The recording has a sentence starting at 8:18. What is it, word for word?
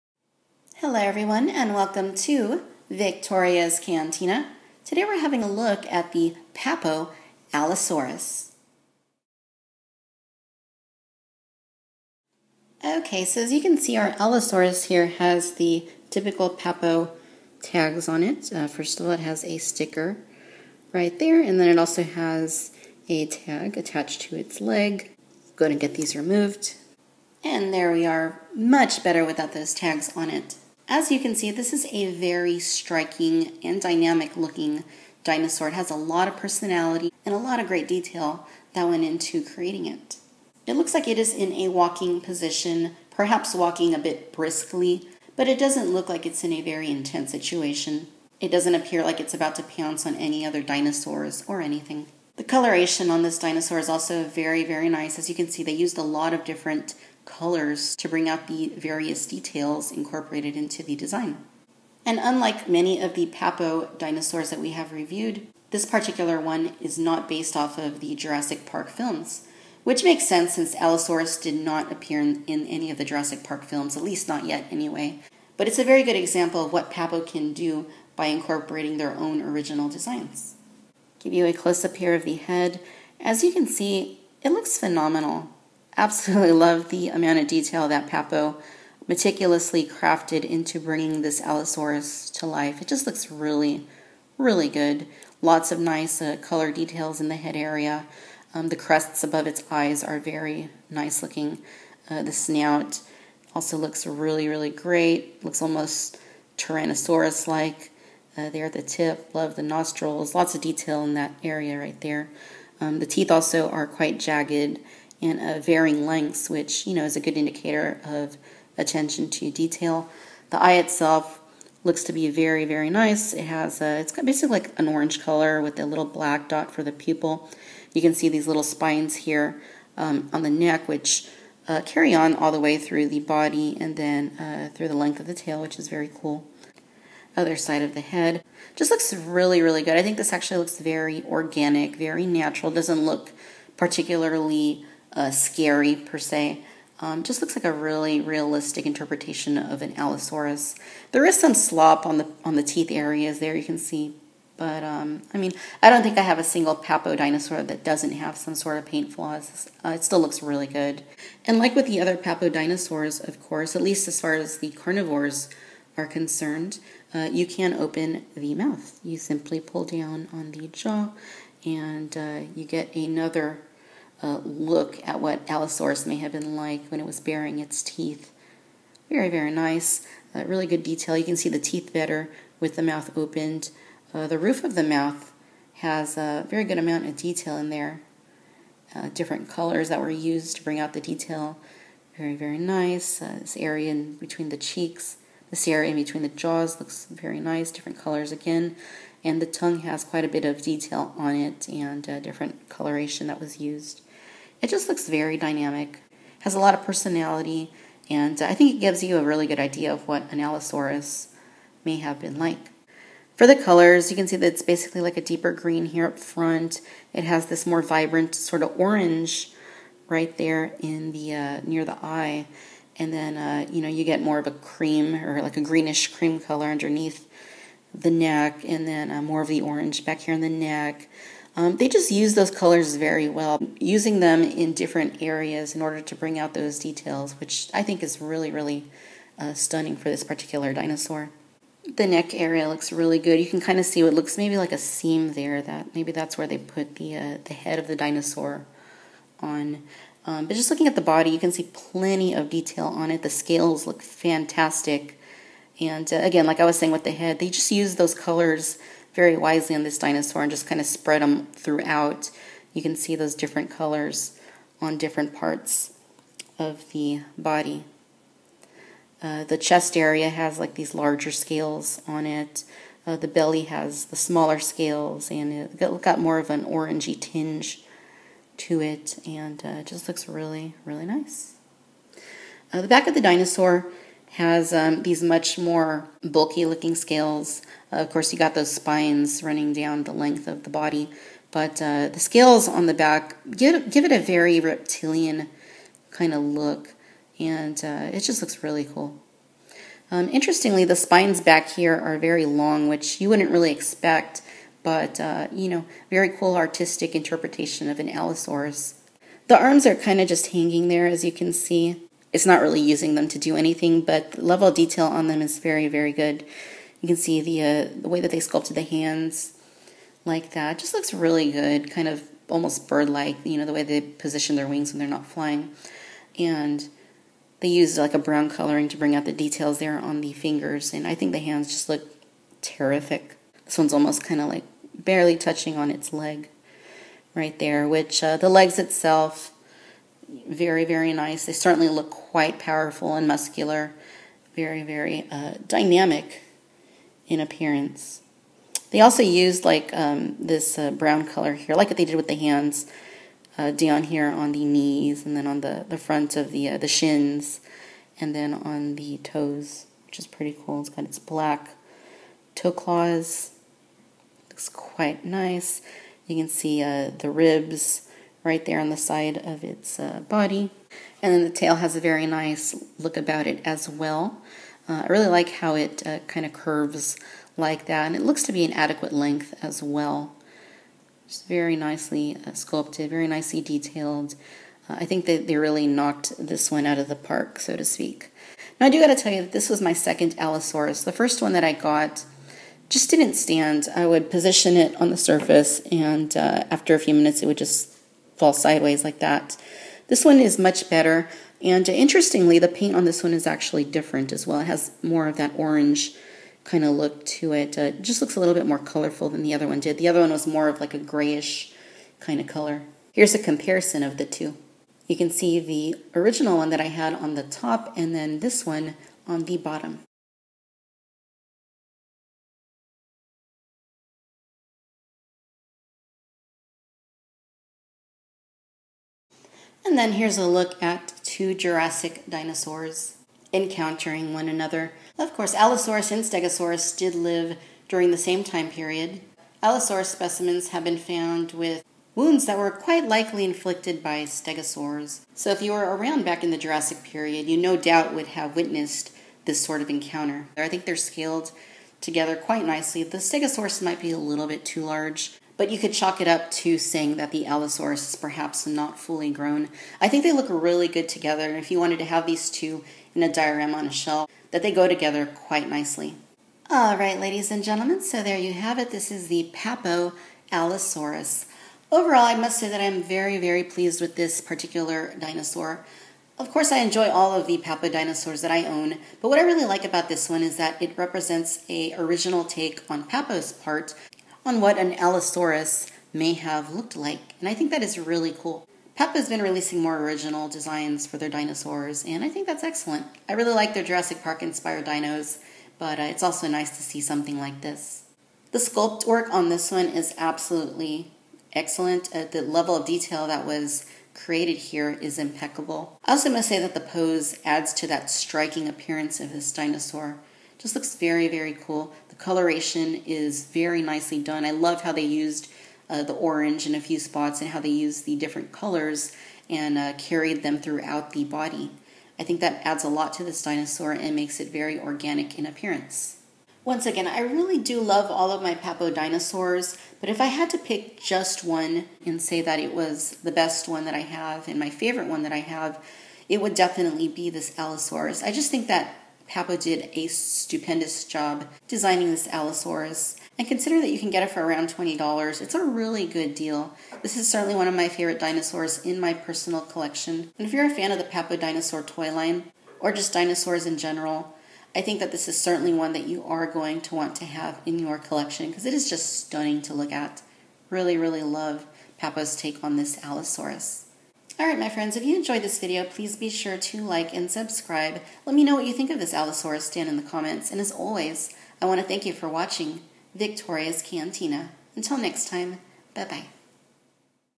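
The sculpt work on this one is absolutely excellent.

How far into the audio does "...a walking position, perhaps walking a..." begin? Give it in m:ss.
0:41.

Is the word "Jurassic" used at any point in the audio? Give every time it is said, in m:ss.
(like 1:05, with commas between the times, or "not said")
1:08, 1:13, 7:11, 7:26, 8:13.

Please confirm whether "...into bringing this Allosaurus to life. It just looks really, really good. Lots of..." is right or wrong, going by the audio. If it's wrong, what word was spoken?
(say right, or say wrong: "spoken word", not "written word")
right.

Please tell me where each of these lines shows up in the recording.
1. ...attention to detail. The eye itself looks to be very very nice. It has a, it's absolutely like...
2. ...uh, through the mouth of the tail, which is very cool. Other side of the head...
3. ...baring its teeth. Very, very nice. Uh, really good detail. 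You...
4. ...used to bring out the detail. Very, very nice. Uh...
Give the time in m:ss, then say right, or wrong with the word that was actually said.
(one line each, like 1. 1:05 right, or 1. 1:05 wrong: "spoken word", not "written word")
1. 1:58 wrong: "basically", not "absolutely"
2. 2:14 wrong: "length", not "mouth"
3. 2:57 right
4. 3:10 right.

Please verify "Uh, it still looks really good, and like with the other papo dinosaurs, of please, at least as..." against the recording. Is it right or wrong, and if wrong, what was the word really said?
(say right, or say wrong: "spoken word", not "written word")
wrong: "course", not "please".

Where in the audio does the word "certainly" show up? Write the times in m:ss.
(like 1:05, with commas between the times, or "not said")
5:41, 9:07, 9:15.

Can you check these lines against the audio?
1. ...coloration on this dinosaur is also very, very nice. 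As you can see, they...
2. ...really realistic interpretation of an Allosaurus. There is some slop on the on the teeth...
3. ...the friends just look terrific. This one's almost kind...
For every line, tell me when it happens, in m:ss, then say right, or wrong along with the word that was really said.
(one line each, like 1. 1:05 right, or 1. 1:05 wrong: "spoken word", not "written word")
1. 0:52 right
2. 2:27 right
3. 5:31 wrong: "hands", not "friends".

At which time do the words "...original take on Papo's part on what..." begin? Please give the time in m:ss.
8:01.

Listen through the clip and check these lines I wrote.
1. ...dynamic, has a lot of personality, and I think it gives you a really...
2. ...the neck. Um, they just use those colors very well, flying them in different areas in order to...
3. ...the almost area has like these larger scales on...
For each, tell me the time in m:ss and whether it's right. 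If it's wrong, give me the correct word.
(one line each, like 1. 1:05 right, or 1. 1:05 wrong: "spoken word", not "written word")
1. 3:25 right
2. 3:50 wrong: "using", not "flying"
3. 4:29 wrong: "chest", not "almost".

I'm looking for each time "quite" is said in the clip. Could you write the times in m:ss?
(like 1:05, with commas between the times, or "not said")
1:53, 3:20, 5:42, 6:04, 7:22, 7:32, 7:45.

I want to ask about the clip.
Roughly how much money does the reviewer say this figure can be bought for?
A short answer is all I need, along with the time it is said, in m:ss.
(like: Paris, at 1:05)
$20, at 9:04.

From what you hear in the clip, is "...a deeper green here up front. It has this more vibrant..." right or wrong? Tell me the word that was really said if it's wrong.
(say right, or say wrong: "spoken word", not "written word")
right.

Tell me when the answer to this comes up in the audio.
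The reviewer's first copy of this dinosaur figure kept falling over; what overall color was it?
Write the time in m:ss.
6:50.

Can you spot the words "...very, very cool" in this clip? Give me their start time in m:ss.
8:30.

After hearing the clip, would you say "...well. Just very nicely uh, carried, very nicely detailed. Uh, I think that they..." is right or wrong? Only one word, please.
wrong.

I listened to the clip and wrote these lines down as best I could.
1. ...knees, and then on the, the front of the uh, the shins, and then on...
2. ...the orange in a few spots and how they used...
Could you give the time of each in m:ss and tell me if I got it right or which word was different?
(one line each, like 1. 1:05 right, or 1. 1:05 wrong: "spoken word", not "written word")
1. 5:54 right
2. 8:36 right.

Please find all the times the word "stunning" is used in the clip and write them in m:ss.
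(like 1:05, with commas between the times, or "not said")
3:59, 9:19.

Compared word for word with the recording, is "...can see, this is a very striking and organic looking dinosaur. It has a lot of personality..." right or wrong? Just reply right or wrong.
wrong.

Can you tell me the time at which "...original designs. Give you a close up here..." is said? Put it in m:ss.
1:19.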